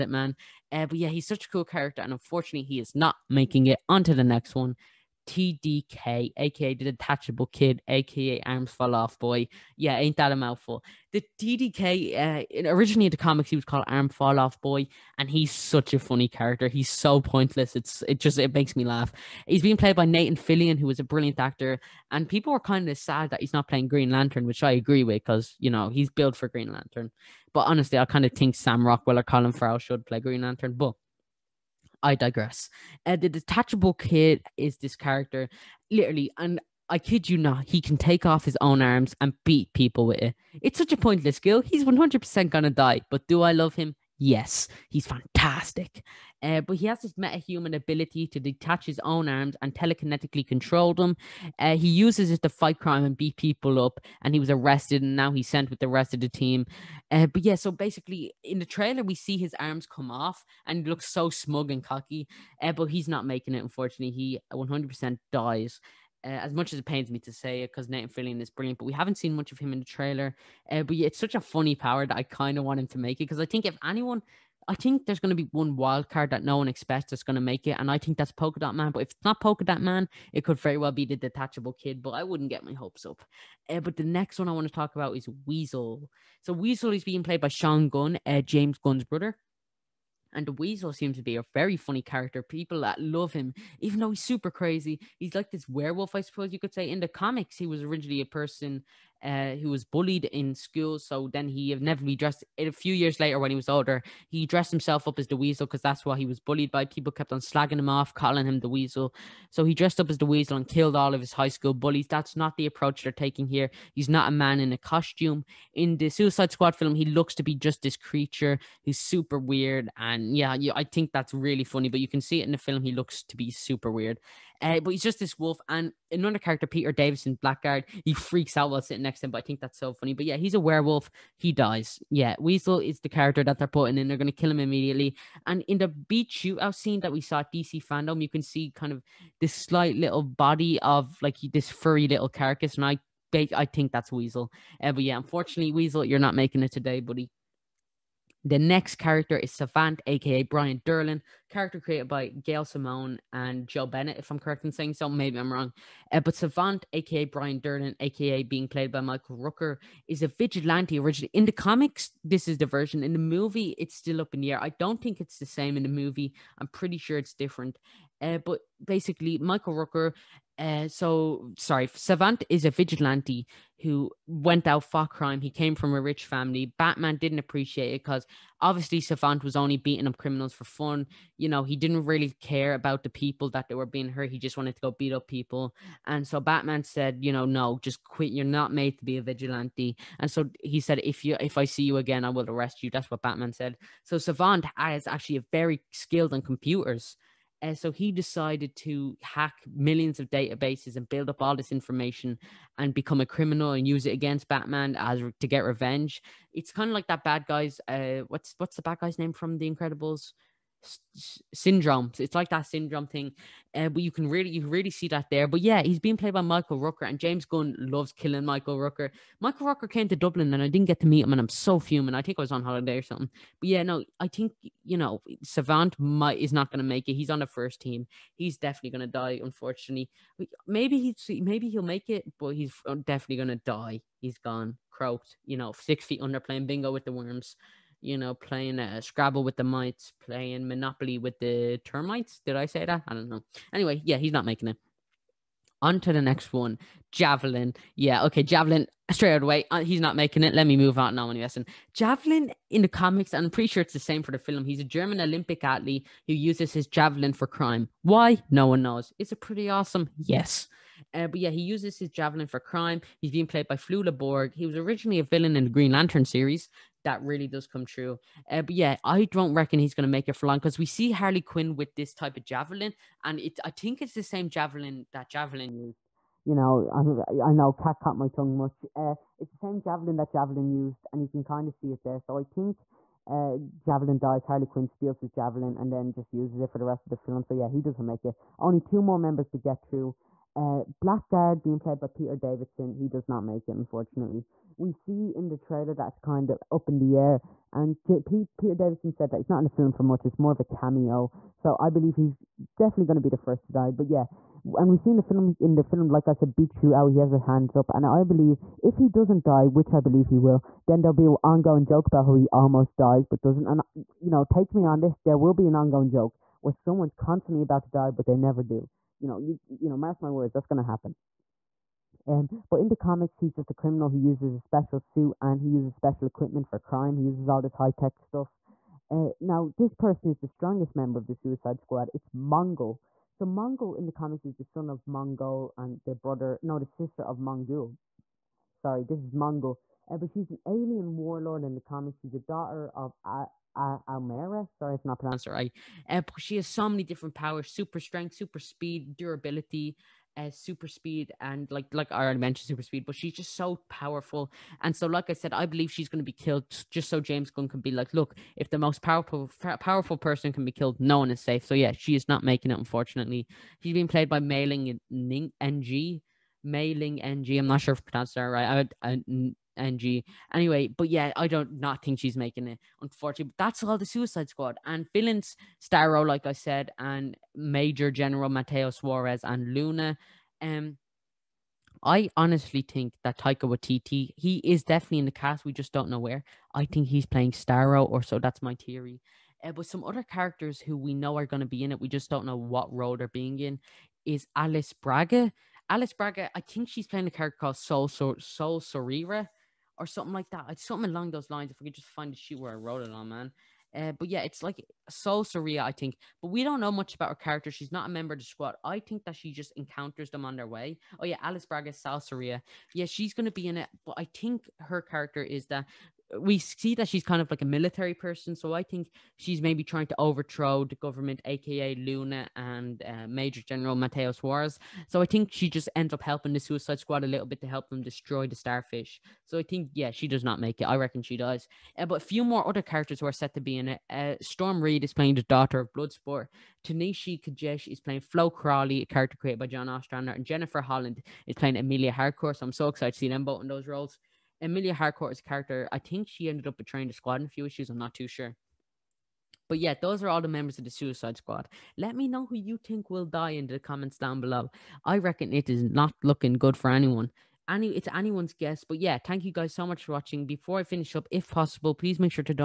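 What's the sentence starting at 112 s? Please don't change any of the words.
That's not the approach they're taking here.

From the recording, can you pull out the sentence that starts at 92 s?
People that love him, even though he's super crazy.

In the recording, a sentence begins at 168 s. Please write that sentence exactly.
Eh, but basically, Michael Rooker, uh, so sorry, Savant is a vigilante who went out for crime.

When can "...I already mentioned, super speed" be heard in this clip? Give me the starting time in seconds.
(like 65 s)
352 s.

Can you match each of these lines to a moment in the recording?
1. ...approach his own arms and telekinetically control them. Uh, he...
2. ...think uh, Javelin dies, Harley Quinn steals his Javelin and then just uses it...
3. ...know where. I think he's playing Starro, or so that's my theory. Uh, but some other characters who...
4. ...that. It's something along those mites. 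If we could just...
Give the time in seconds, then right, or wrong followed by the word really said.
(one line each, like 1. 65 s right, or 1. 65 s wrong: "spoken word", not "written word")
1. 48 s wrong: "detach", not "approach"
2. 282 s right
3. 386 s right
4. 400 s wrong: "lines", not "mites".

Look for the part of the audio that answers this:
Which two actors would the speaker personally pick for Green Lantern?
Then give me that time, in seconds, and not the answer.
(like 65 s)
28 s.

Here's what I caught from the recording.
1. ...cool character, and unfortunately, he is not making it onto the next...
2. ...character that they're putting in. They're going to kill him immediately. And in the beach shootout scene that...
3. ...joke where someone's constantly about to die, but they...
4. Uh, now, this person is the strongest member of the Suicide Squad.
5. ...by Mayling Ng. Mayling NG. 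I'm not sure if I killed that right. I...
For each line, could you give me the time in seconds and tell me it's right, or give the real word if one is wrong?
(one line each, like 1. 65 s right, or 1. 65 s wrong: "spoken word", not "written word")
1. 1 s right
2. 133 s right
3. 316 s right
4. 329 s right
5. 364 s wrong: "pronounced", not "killed".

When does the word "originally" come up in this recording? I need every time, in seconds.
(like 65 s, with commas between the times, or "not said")
12 s, 97 s, 160 s, 264 s.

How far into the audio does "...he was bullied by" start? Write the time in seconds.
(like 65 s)
106 s.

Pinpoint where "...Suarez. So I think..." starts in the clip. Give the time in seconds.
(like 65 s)
424 s.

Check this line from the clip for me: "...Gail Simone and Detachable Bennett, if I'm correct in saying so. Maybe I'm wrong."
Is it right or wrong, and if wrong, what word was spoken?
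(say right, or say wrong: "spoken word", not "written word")
wrong: "Joe", not "Detachable".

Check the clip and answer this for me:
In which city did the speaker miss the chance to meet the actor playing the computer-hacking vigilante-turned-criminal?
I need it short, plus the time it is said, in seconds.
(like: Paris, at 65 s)
Dublin, at 220 s.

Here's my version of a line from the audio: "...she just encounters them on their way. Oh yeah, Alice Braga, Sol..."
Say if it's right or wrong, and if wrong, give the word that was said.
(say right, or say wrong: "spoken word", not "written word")
right.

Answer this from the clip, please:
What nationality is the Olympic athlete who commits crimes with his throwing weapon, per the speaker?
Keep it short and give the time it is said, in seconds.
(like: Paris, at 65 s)
German, at 254 s.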